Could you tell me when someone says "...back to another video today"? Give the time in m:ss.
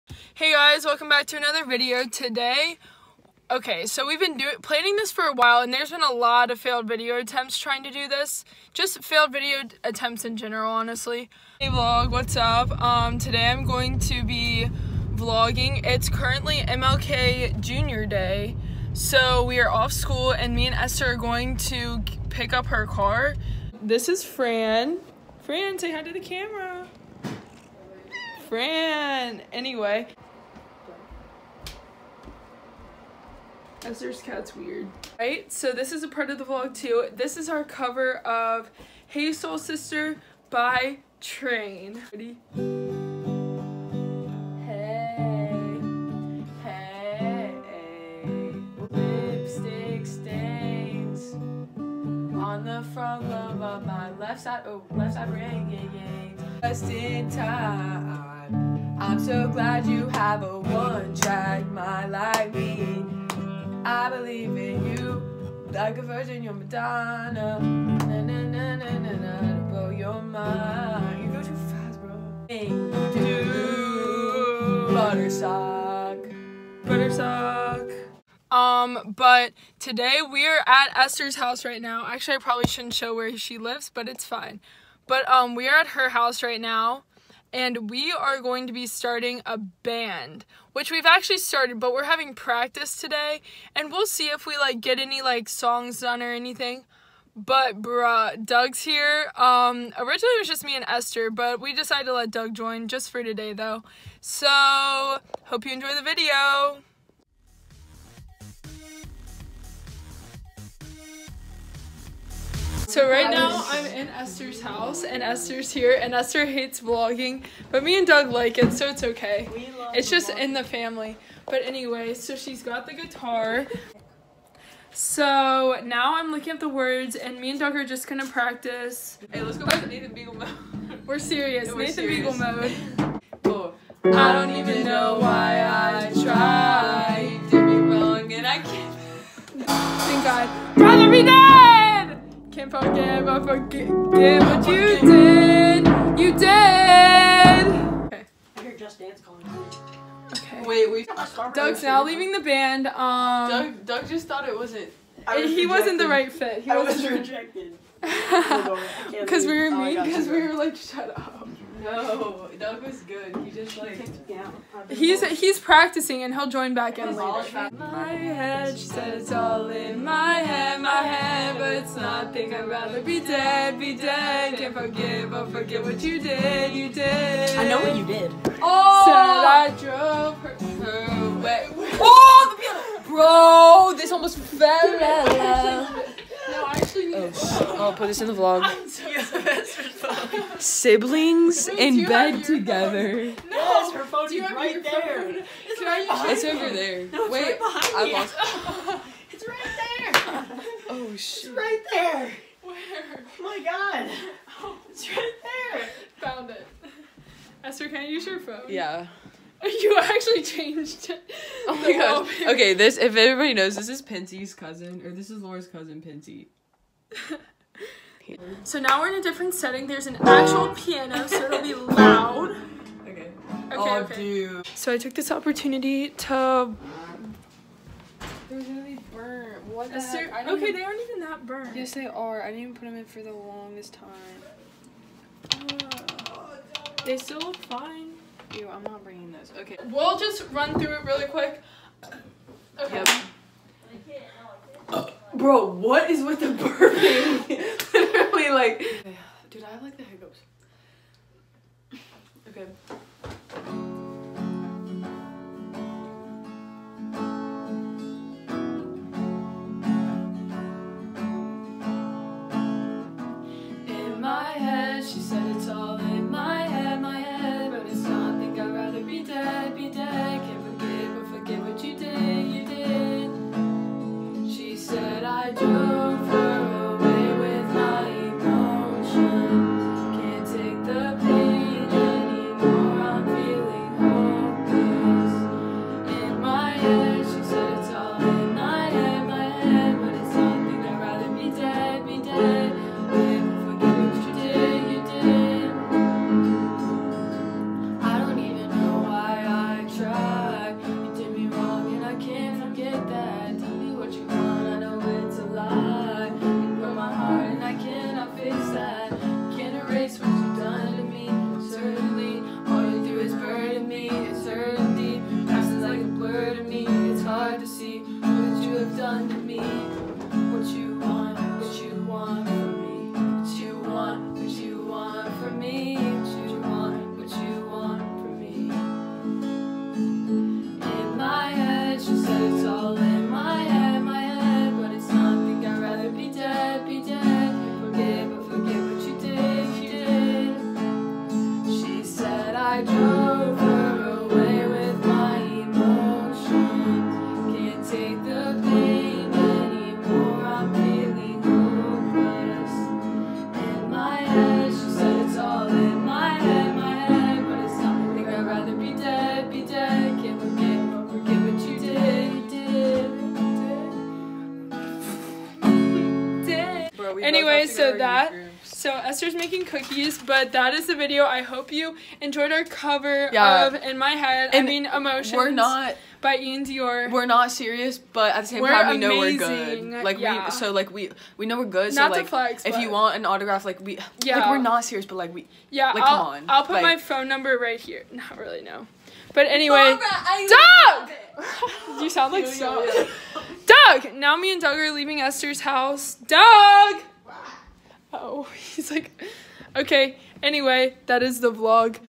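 0:01.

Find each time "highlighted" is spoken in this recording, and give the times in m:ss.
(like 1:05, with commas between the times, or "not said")
not said.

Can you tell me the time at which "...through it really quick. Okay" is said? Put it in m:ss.
4:00.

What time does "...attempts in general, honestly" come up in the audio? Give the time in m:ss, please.
0:09.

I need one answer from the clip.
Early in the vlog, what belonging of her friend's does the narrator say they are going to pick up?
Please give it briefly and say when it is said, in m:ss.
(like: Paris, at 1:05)
her car, at 0:22.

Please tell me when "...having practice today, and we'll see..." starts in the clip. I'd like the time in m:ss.
1:32.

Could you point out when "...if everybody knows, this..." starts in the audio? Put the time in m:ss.
3:32.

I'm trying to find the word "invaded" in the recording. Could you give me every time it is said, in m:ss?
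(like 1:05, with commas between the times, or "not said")
not said.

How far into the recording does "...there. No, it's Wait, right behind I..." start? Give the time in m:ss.
3:16.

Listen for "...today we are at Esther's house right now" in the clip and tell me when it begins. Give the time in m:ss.
1:19.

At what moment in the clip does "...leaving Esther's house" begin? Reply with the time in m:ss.
6:34.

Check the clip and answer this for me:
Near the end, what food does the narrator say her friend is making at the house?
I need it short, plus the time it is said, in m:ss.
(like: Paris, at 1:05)
cookies, at 6:09.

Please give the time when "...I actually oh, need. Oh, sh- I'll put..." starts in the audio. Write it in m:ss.
3:06.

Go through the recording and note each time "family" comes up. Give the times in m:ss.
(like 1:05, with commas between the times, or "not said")
2:00.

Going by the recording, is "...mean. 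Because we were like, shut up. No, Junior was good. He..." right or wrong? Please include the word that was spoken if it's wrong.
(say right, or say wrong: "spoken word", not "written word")
wrong: "Doug", not "Junior".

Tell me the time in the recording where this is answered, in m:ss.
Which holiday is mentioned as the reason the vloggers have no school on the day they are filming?
0:16.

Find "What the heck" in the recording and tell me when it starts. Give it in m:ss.
3:49.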